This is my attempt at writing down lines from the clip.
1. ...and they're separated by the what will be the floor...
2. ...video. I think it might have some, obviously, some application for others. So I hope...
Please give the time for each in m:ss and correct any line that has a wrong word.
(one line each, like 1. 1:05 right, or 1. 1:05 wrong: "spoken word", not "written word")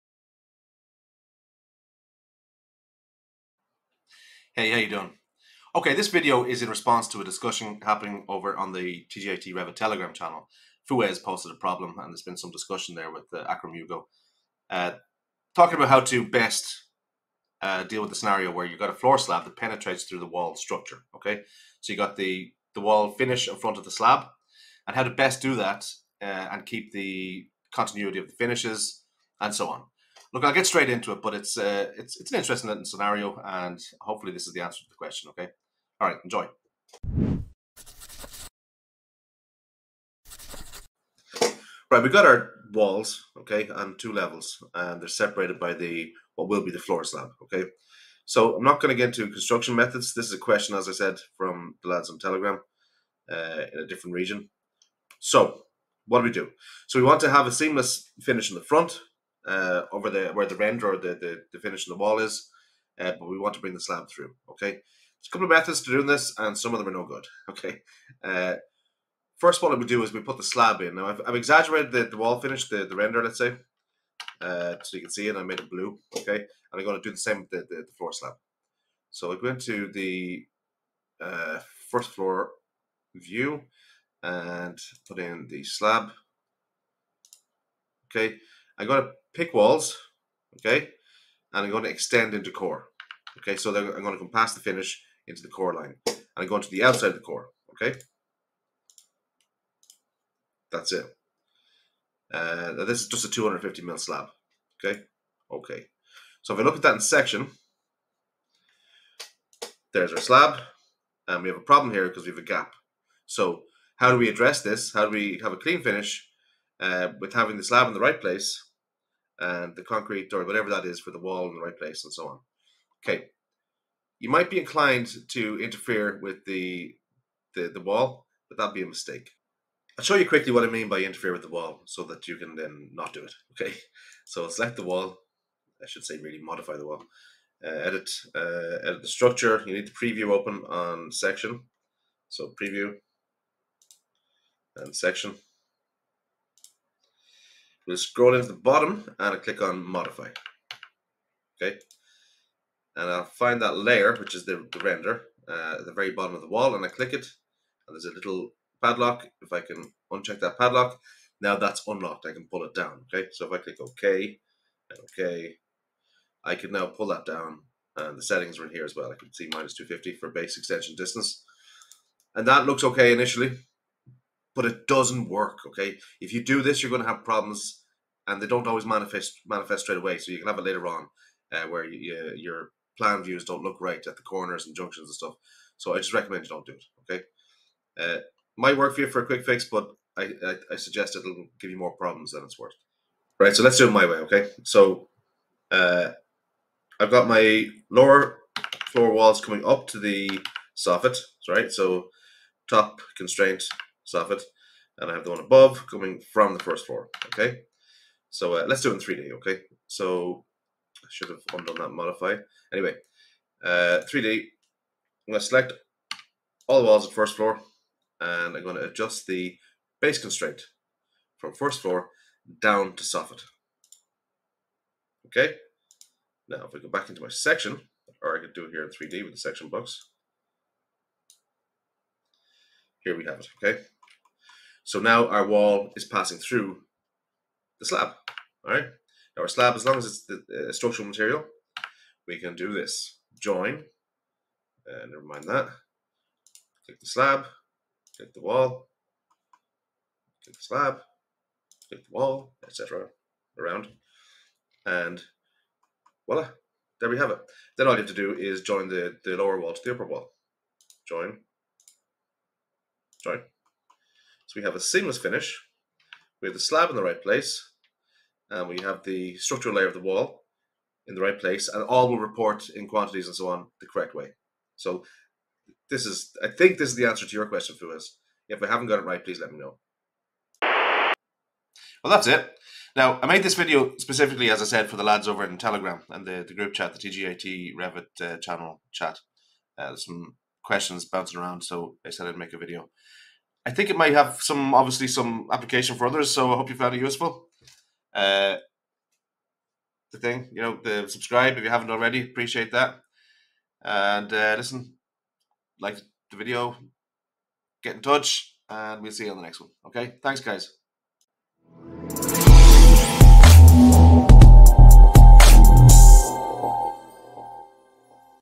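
1. 0:44 right
2. 4:52 right.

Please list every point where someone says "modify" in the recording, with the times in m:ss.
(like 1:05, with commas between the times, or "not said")
2:16, 2:29, 3:31.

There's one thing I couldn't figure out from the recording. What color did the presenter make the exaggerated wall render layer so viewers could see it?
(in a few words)
Blue.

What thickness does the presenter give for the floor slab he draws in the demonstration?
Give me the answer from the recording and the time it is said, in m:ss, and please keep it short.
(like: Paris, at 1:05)
250 mil, at 1:43.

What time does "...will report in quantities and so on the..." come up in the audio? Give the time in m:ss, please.
4:32.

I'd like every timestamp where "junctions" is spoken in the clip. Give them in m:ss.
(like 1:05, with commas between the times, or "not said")
3:04.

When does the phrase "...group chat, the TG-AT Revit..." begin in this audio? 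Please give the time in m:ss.
4:46.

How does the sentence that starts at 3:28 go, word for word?
So uh, let's do it in 3D, okay?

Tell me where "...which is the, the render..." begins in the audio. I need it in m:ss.
2:34.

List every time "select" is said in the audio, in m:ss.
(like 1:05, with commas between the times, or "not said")
2:14, 3:35.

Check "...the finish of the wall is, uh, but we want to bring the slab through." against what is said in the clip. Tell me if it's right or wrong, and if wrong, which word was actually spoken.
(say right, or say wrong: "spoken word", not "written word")
right.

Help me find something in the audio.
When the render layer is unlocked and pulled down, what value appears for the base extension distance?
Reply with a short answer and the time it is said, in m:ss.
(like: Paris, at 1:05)
-250, at 2:49.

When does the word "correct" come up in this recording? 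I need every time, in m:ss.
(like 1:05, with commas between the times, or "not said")
4:33.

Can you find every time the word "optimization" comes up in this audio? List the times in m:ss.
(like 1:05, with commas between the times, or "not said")
not said.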